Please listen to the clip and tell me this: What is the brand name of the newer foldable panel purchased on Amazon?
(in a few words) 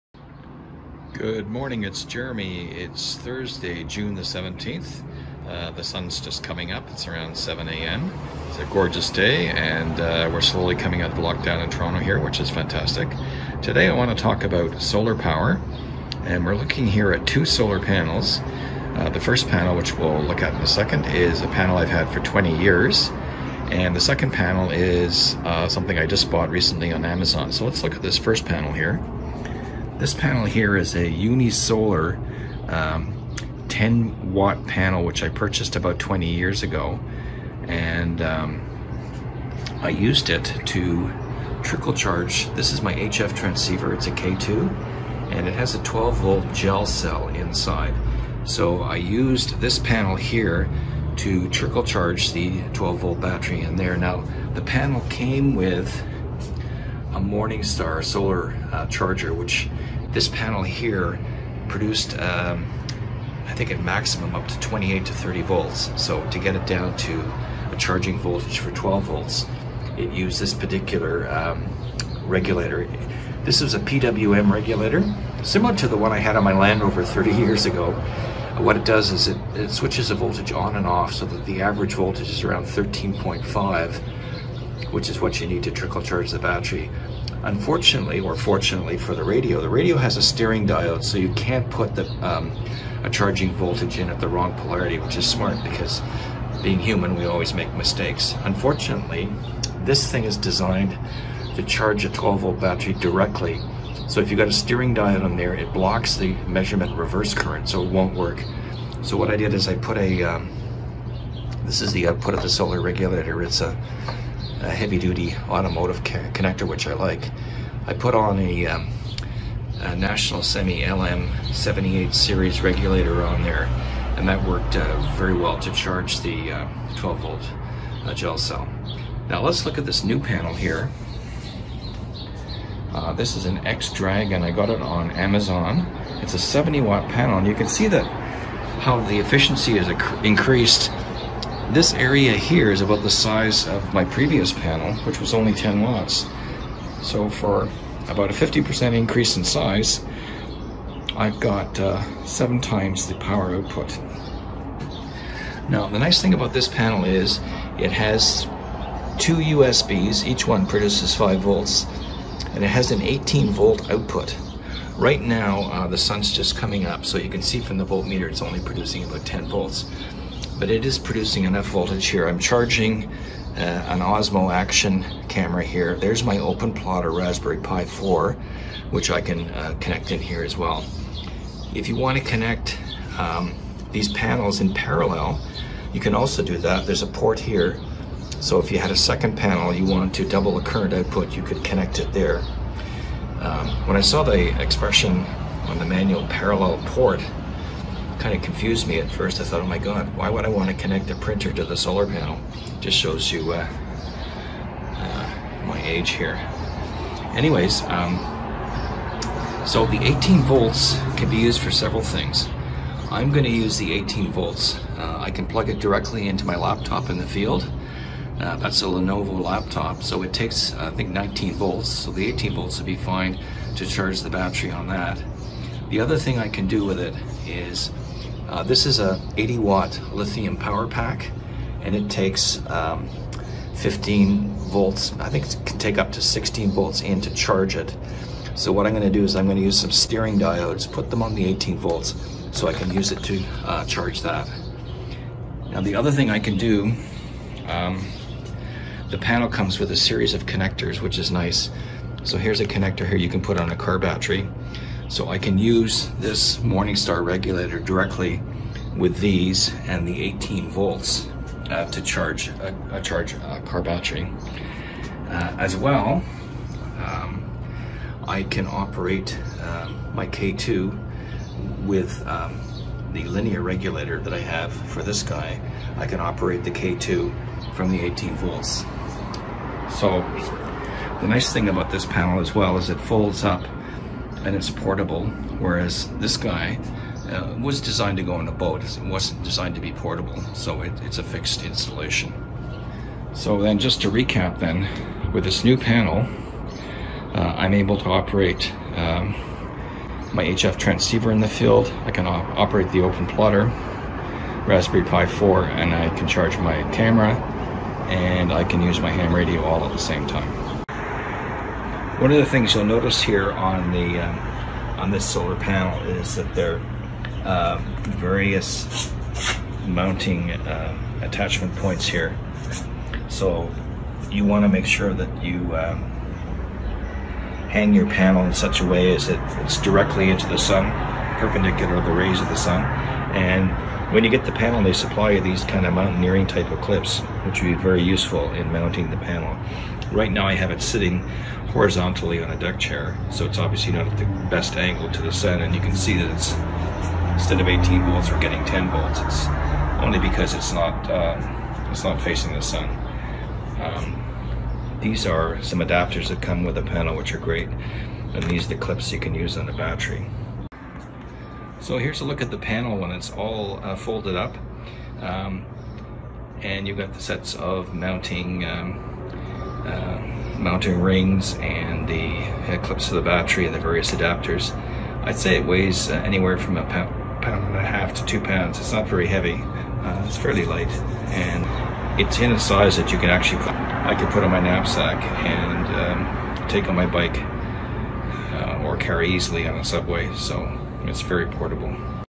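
X-Dragon.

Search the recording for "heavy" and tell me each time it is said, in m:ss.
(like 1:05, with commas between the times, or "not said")
1:54, 6:19.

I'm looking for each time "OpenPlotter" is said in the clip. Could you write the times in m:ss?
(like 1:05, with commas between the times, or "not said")
2:56, 5:02.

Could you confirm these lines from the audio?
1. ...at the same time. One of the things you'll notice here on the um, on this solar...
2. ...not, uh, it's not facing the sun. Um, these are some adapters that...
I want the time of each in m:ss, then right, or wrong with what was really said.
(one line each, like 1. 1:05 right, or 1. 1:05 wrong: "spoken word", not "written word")
1. 5:09 right
2. 5:50 right.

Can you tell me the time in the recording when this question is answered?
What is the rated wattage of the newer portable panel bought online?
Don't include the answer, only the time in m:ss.
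2:16.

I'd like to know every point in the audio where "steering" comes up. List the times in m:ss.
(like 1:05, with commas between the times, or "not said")
1:30, 1:44, 3:59.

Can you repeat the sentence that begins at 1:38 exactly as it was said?
Unfortunately, this thing is designed to charge a 12 volt battery directly.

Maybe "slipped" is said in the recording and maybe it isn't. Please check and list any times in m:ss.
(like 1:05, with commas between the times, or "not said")
not said.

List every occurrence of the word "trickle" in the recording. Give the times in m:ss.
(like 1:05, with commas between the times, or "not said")
0:41, 0:51, 1:25.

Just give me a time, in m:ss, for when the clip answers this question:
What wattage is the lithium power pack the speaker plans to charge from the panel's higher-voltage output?
3:49.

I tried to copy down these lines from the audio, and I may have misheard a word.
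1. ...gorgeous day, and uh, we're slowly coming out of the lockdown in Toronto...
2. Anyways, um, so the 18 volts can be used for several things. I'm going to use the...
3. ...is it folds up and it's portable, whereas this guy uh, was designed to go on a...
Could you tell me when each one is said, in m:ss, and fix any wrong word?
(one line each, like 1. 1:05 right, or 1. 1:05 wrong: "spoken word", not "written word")
1. 0:08 right
2. 3:27 right
3. 4:42 right.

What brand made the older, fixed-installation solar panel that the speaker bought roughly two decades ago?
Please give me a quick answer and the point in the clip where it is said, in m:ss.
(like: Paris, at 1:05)
Unisolar, at 0:31.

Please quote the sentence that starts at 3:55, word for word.
I think it can take up to 16 volts in to charge it.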